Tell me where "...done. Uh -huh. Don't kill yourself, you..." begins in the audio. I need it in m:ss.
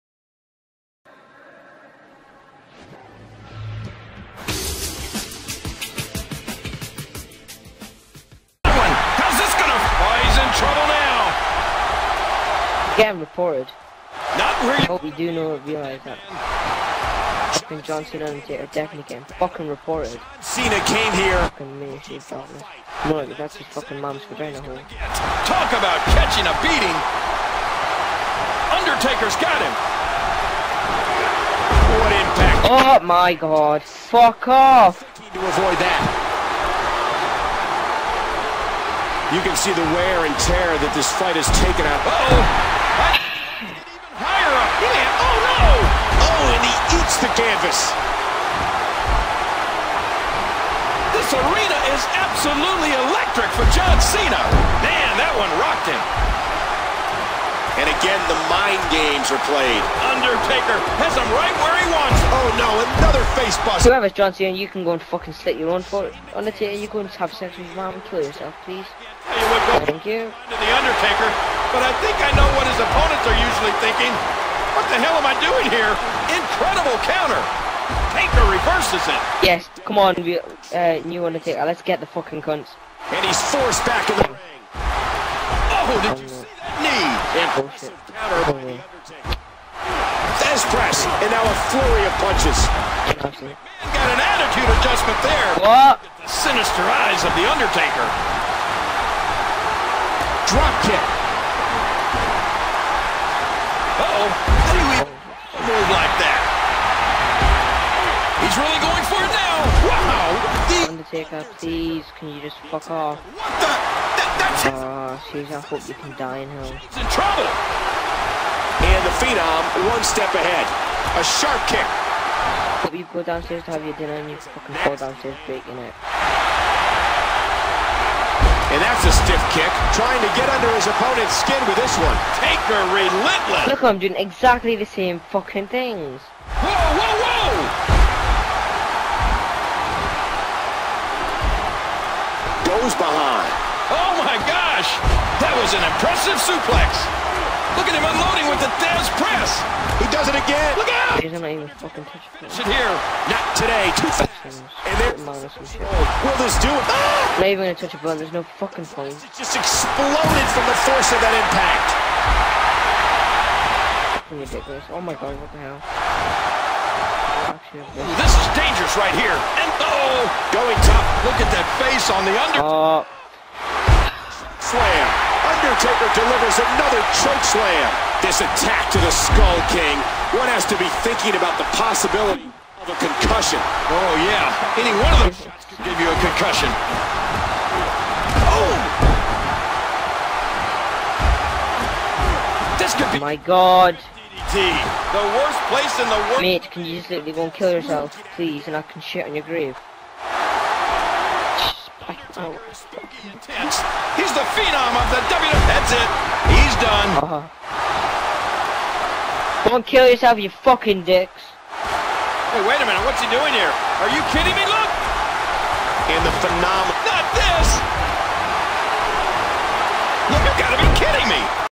3:26.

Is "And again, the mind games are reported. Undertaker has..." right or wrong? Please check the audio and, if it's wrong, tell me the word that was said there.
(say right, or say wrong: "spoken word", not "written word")
wrong: "played", not "reported".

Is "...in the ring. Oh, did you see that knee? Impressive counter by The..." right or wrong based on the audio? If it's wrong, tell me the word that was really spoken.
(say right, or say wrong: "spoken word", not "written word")
right.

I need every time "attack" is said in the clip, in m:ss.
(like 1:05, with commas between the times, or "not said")
2:58.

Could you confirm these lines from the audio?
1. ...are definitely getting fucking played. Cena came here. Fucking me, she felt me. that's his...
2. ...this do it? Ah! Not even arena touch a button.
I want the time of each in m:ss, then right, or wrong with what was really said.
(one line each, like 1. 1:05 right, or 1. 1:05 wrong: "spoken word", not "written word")
1. 0:18 wrong: "reported", not "played"
2. 2:36 wrong: "gonna", not "arena".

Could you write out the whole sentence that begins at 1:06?
Undertaker, you go and have sex with your mom and kill yourself, please would go Thank you.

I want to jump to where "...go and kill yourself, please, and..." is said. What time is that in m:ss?
3:17.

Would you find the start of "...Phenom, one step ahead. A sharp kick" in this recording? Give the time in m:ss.
1:59.